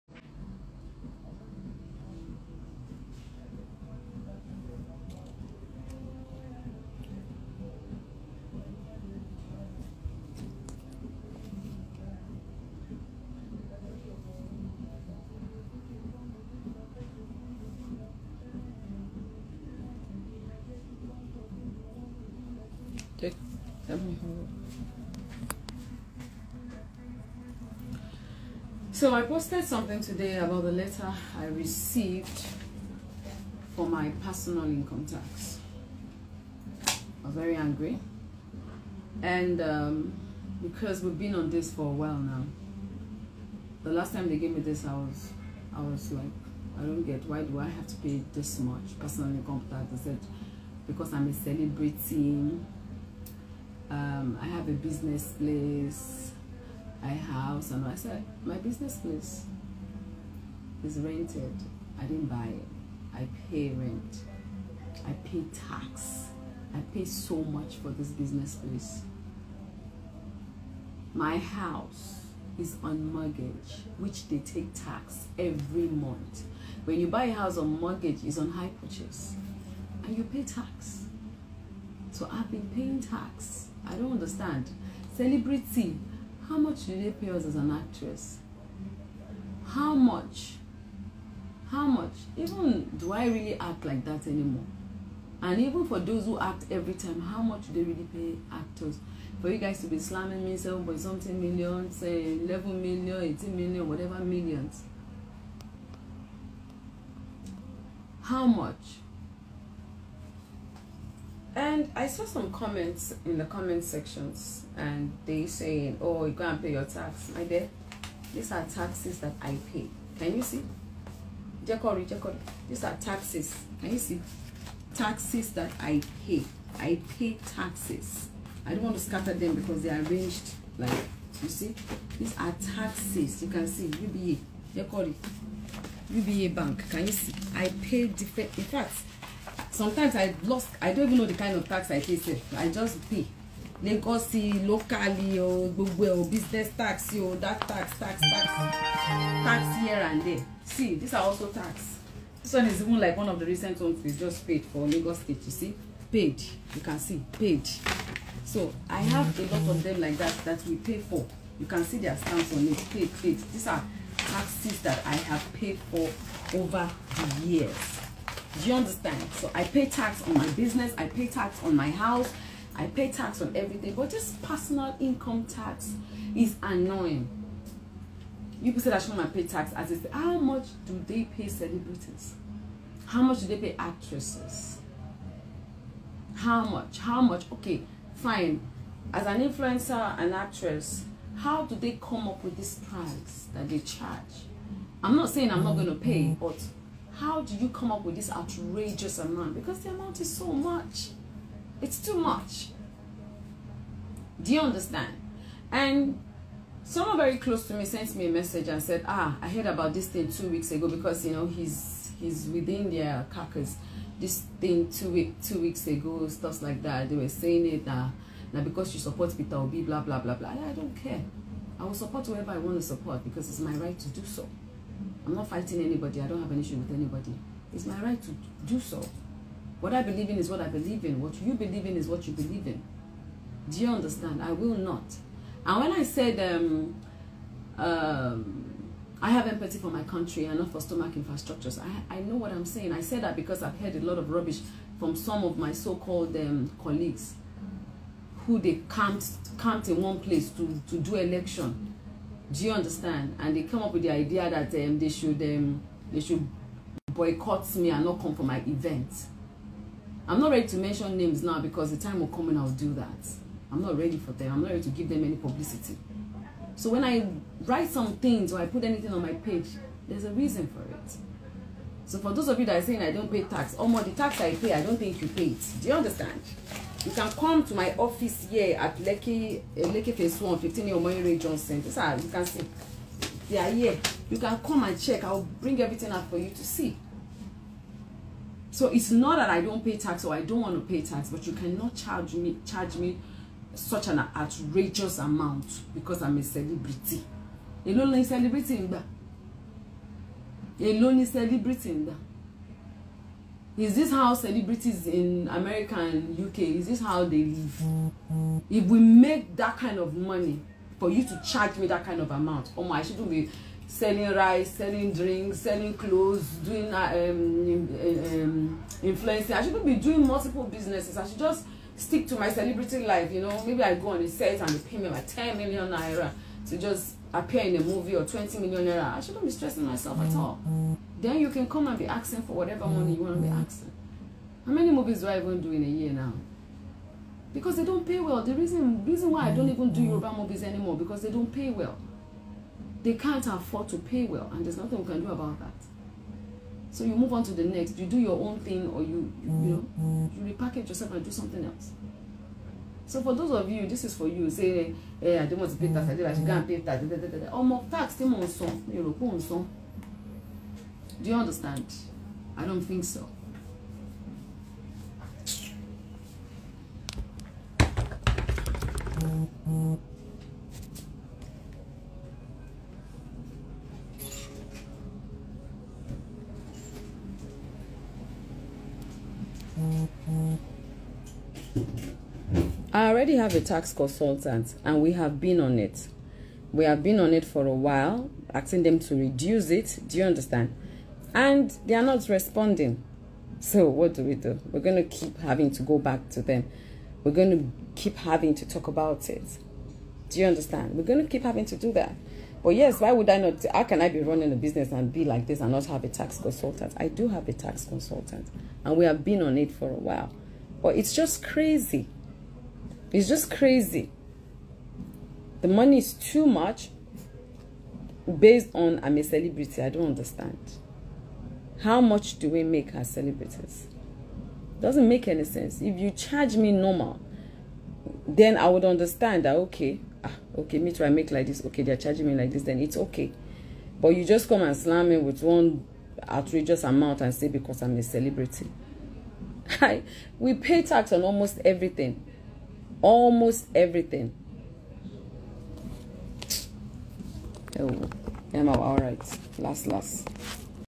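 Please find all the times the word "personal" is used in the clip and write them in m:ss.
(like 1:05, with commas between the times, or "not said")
0:34, 0:48, 2:54.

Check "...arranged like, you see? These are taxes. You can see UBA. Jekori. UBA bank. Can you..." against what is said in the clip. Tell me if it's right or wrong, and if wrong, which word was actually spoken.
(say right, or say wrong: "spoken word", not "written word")
right.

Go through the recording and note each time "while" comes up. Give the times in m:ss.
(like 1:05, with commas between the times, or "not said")
0:41, 6:27, 6:49.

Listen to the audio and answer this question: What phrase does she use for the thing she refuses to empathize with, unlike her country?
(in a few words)
stomach infrastructures.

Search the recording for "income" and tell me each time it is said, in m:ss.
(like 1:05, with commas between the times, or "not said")
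0:34, 0:49, 2:54.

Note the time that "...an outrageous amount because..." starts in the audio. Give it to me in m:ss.
4:54.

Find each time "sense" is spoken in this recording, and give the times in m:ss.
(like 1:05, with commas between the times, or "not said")
7:05.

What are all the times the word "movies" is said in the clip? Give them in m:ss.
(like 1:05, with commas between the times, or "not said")
5:27, 5:34, 5:40.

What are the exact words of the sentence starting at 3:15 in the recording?
I'm not saying I'm not going to pay, but how do you come up with this outrageous amount?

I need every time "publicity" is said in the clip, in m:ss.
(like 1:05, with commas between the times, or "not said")
4:25.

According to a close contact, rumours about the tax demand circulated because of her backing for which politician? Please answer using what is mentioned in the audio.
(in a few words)
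Peter Obi.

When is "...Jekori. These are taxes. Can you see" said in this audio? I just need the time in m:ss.
2:02.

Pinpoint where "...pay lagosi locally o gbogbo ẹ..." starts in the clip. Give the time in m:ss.
2:23.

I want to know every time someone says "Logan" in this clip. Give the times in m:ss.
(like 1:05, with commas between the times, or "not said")
not said.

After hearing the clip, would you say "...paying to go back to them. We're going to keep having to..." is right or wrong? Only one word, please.
wrong.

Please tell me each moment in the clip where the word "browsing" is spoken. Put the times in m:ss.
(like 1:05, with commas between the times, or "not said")
not said.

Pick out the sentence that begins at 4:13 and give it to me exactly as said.
And they come up with the idea that um, they should um, they should boycott me and not come for my event.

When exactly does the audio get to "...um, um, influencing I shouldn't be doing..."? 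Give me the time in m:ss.
5:17.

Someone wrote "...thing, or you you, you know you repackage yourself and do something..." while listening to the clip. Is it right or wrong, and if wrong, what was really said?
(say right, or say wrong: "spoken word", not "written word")
right.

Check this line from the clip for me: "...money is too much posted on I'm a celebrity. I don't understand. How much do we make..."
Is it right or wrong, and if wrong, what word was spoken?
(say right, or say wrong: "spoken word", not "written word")
wrong: "based", not "posted".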